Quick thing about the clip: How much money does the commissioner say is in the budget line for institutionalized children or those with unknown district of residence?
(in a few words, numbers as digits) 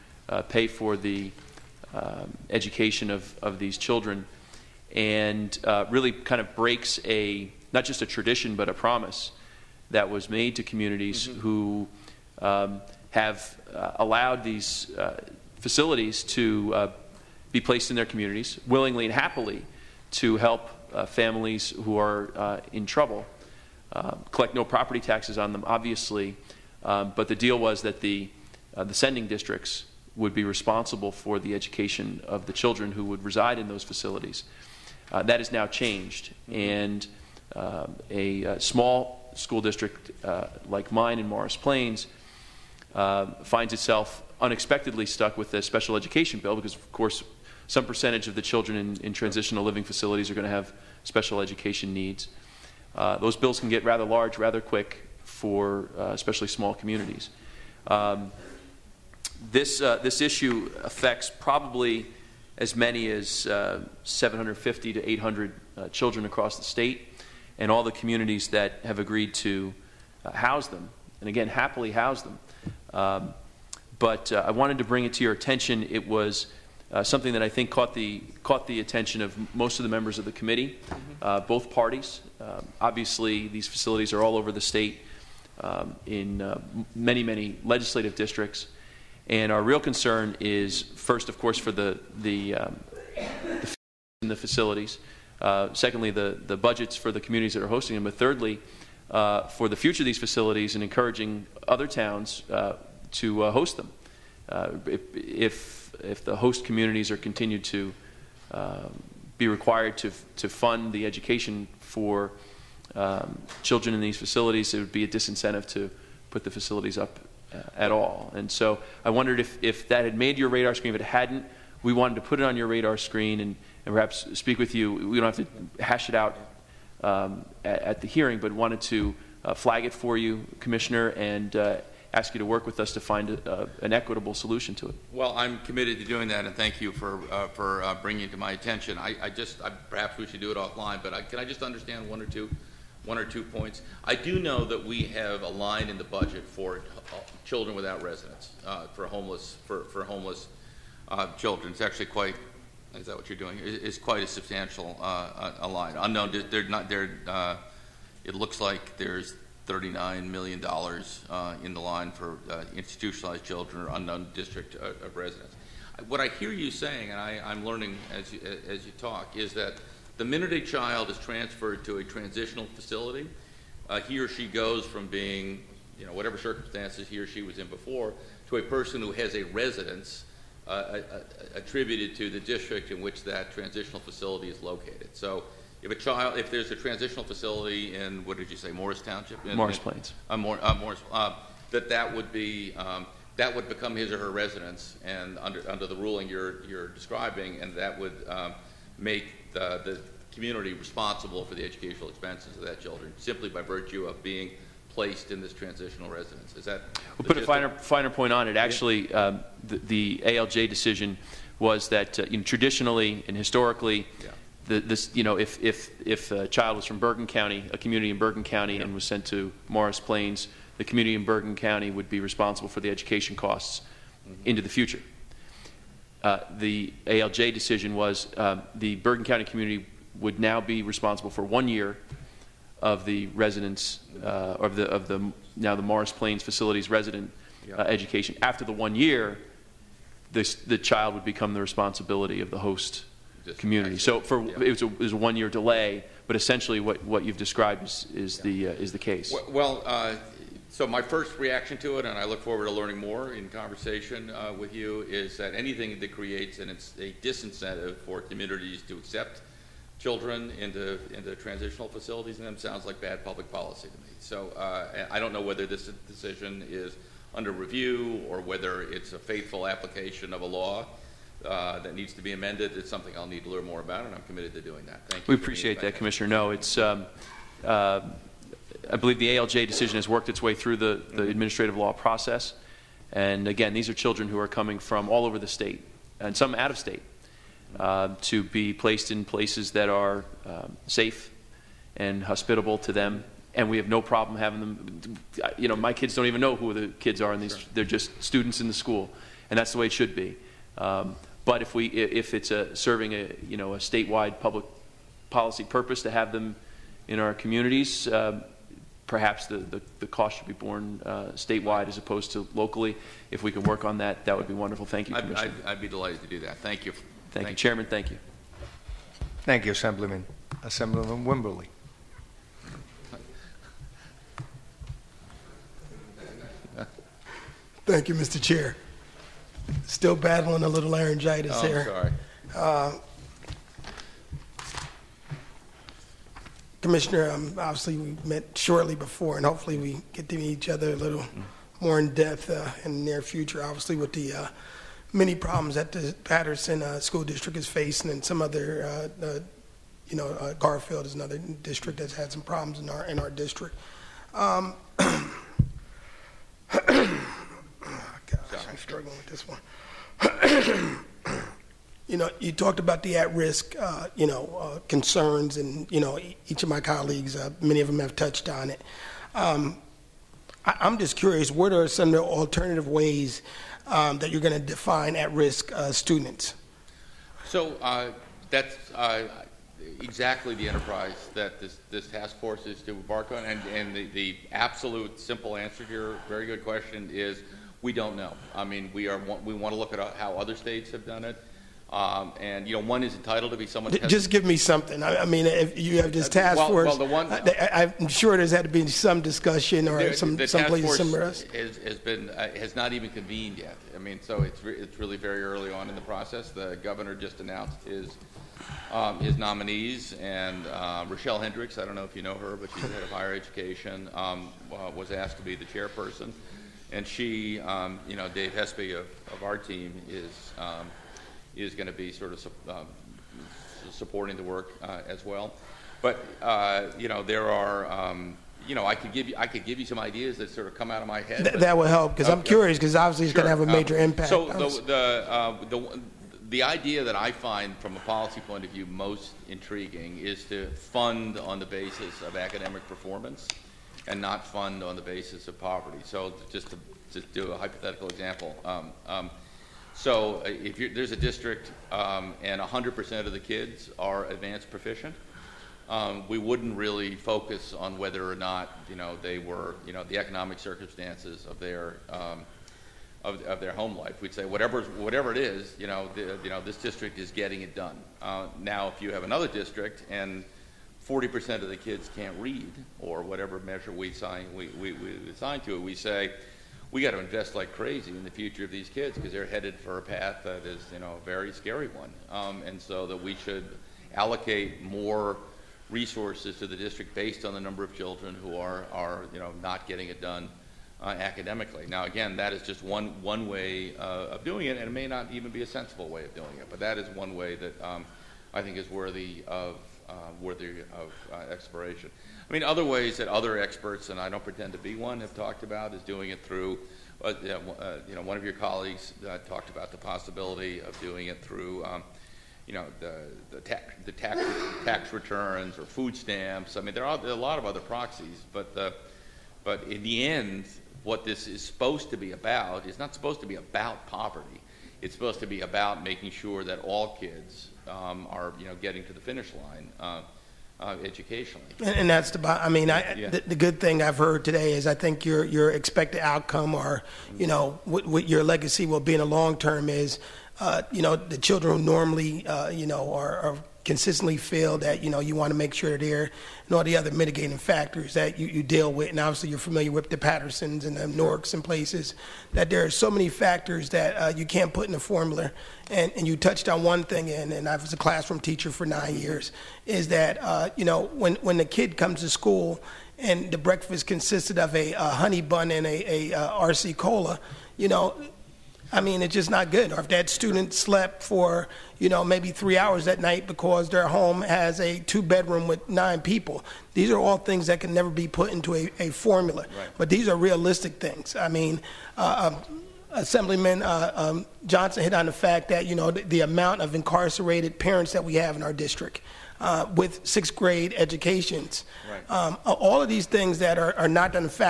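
$39 million.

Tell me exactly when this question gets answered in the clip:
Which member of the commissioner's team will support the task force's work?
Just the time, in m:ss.
6:58.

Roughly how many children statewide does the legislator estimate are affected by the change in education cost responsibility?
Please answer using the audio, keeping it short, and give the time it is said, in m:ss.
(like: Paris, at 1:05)
750 to 800, at 1:04.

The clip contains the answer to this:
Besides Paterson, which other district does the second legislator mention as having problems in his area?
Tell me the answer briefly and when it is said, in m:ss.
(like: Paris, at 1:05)
Garfield, at 5:50.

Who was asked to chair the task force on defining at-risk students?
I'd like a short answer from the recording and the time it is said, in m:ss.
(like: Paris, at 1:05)
Rochelle Hendricks, at 6:51.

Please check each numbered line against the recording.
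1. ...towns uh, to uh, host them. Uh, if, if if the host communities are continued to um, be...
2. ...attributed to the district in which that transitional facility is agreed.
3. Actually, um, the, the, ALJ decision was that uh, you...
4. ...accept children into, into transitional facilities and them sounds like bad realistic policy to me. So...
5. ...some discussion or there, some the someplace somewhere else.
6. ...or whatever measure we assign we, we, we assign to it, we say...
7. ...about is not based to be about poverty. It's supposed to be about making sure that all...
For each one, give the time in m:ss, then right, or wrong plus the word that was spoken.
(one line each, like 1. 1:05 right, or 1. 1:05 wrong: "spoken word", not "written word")
1. 1:41 right
2. 3:01 wrong: "located", not "agreed"
3. 3:28 right
4. 4:18 wrong: "public", not "realistic"
5. 6:38 right
6. 7:52 right
7. 8:42 wrong: "supposed", not "based".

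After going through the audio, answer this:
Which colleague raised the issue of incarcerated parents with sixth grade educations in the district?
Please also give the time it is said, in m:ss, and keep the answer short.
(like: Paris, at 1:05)
Johnson, at 9:44.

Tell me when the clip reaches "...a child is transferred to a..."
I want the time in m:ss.
2:50.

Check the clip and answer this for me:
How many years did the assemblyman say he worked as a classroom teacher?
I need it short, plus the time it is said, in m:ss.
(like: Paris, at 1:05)
9, at 9:18.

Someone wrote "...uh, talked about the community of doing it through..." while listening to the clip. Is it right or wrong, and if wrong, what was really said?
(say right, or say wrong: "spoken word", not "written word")
wrong: "possibility", not "community".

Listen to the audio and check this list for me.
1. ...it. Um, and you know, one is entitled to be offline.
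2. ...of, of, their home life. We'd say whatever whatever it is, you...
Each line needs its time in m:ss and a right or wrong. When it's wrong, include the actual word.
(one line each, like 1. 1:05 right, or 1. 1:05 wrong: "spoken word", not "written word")
1. 6:31 wrong: "someone", not "offline"
2. 7:43 right.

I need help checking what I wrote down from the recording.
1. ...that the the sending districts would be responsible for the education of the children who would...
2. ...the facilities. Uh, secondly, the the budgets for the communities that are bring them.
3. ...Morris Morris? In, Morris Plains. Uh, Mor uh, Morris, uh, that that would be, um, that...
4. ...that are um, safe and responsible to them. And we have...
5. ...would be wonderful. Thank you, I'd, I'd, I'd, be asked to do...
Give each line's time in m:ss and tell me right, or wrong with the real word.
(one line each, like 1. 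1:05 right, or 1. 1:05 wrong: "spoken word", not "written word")
1. 0:27 right
2. 1:34 wrong: "hosting", not "bring"
3. 3:08 wrong: "Township", not "Morris"
4. 4:49 wrong: "hospitable", not "responsible"
5. 5:14 wrong: "delighted", not "asked".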